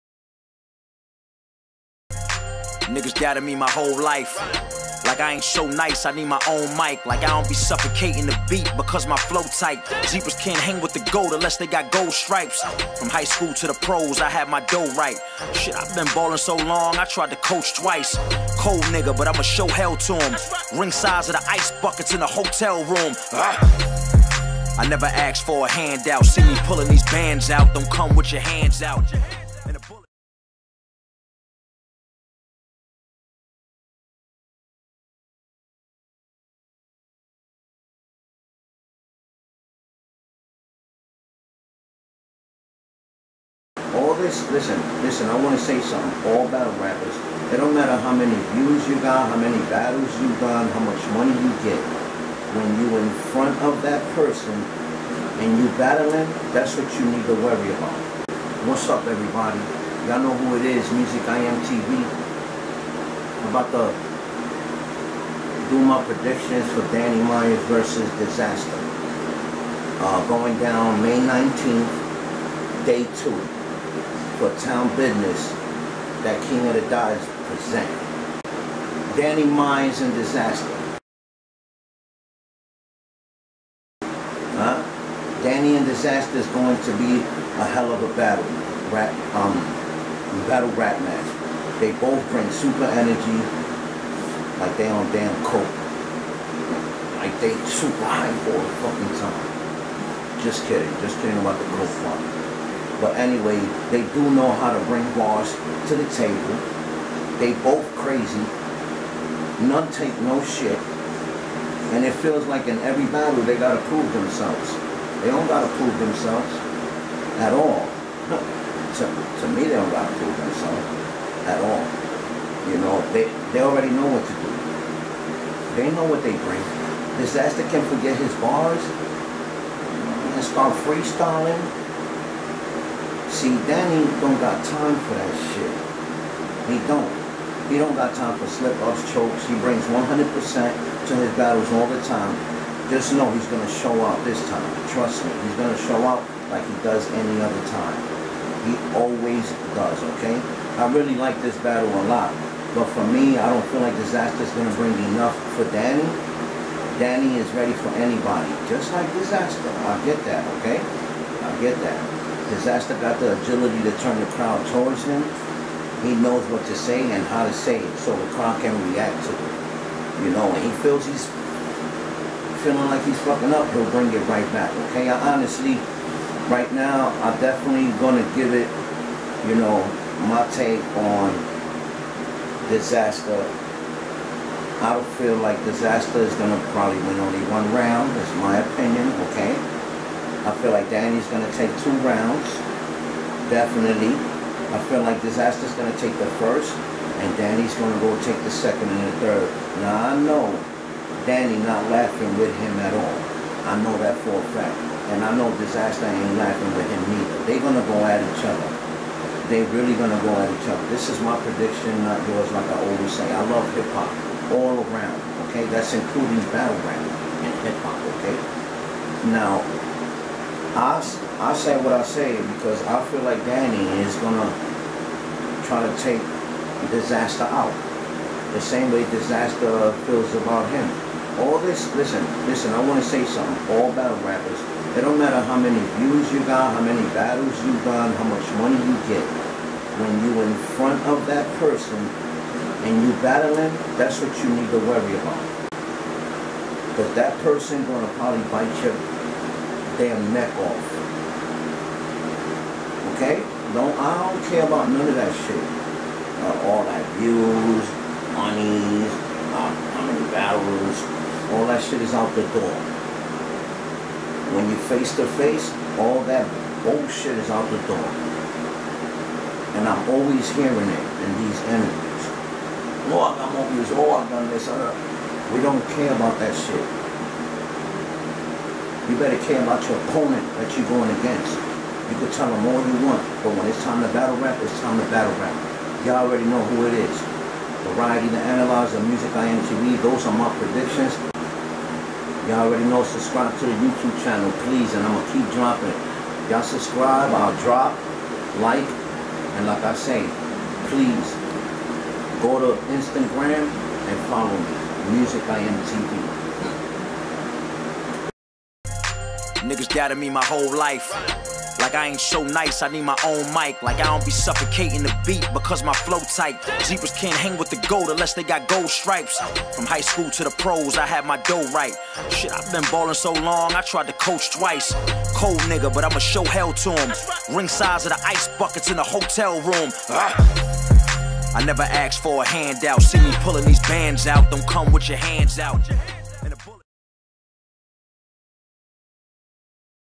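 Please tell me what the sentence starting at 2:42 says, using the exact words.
Dizaster got the agility to turn the crowd towards him.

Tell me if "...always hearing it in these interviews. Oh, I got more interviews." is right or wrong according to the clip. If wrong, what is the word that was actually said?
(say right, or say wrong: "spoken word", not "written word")
wrong: "views", not "interviews".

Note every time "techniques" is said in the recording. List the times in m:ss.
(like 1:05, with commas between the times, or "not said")
not said.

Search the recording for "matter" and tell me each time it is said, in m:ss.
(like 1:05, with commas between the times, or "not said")
0:47, 3:55.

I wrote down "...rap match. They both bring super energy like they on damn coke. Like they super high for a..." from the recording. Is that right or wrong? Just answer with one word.
right.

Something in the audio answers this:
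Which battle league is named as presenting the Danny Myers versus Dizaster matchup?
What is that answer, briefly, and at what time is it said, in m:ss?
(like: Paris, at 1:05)
King of the Dot, at 1:16.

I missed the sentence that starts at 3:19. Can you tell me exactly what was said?
Now, I know Danny not laughing with him at all.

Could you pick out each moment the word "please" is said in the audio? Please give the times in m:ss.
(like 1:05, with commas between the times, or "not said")
4:54, 5:00.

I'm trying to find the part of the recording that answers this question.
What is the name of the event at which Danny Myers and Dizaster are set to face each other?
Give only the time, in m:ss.
1:14.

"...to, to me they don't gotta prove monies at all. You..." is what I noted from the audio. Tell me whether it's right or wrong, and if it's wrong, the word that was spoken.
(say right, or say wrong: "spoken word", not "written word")
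wrong: "themselves", not "monies".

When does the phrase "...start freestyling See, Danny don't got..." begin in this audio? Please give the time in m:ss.
2:10.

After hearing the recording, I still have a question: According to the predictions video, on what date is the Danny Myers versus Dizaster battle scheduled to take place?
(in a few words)
May 19.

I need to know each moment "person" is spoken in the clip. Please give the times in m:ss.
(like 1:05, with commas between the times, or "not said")
0:54, 4:01, 4:07.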